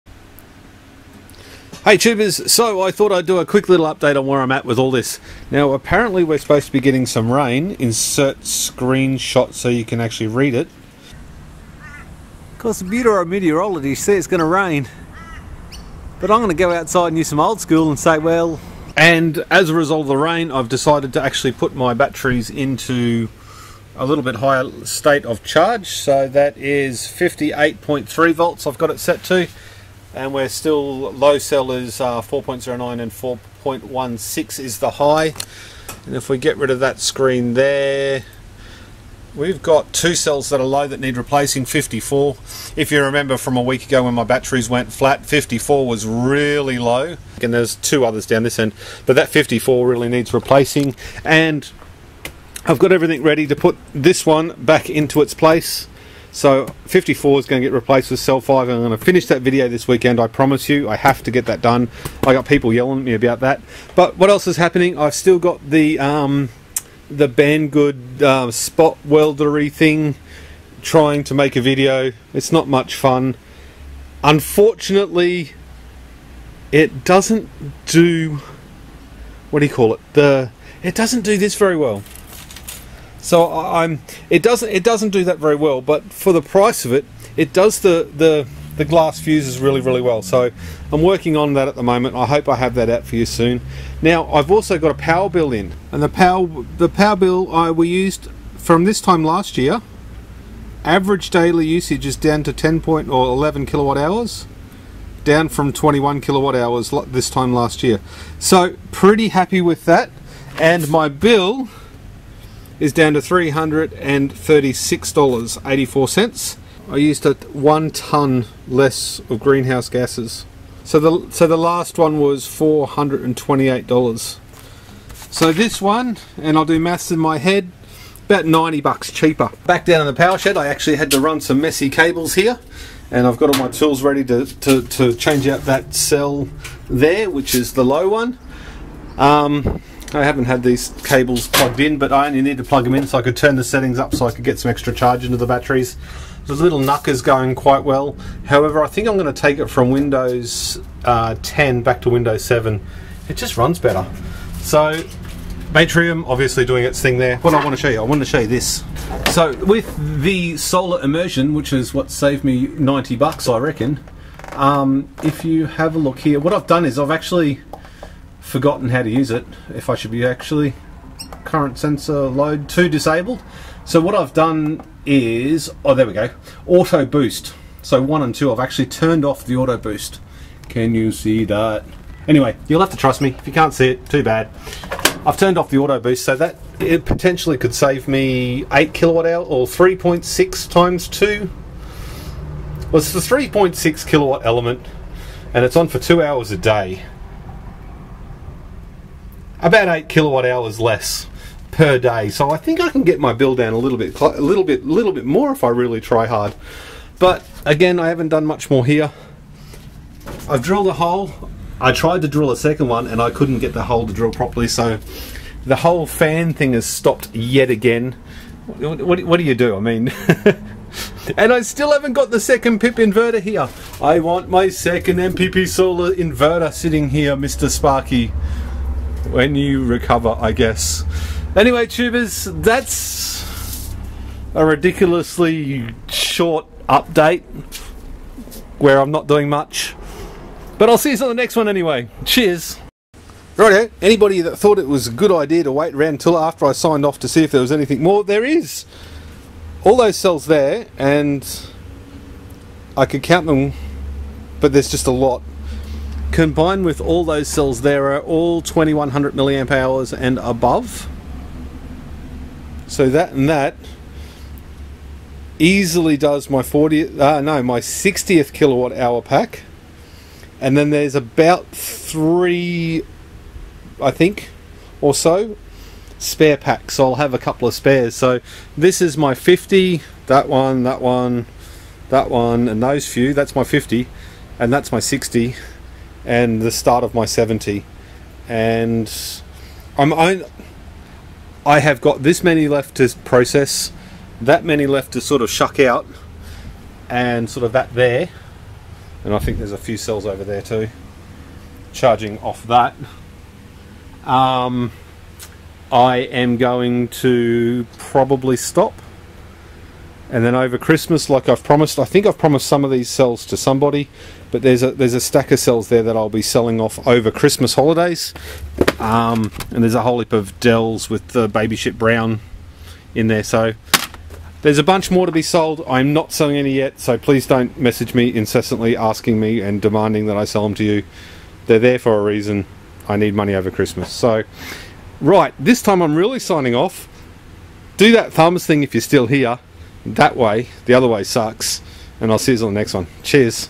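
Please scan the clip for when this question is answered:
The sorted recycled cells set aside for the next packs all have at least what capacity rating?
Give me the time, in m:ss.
4:18.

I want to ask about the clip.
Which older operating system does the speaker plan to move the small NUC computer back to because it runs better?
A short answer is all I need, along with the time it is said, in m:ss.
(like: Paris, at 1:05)
Windows 7, at 2:32.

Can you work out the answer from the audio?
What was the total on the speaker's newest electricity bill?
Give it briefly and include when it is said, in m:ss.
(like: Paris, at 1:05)
$336.84, at 1:53.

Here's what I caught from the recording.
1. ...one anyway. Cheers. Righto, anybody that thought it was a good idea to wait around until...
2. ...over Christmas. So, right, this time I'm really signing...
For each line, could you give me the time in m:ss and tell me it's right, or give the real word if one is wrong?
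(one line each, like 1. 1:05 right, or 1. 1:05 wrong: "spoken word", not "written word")
1. 4:01 right
2. 5:33 right.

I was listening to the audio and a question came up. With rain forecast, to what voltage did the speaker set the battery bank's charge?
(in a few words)
58.3 volts.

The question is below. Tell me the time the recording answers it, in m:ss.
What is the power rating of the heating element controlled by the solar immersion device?
3:13.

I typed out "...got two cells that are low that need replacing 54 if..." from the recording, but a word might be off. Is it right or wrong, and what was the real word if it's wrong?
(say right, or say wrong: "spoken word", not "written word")
right.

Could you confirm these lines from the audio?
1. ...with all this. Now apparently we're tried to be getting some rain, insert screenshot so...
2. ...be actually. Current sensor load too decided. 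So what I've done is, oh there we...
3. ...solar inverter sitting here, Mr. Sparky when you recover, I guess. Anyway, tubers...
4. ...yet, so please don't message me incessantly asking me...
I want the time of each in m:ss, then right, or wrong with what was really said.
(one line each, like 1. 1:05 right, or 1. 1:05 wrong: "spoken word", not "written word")
1. 0:04 wrong: "supposed", not "tried"
2. 2:50 wrong: "disabled", not "decided"
3. 3:45 right
4. 5:26 right.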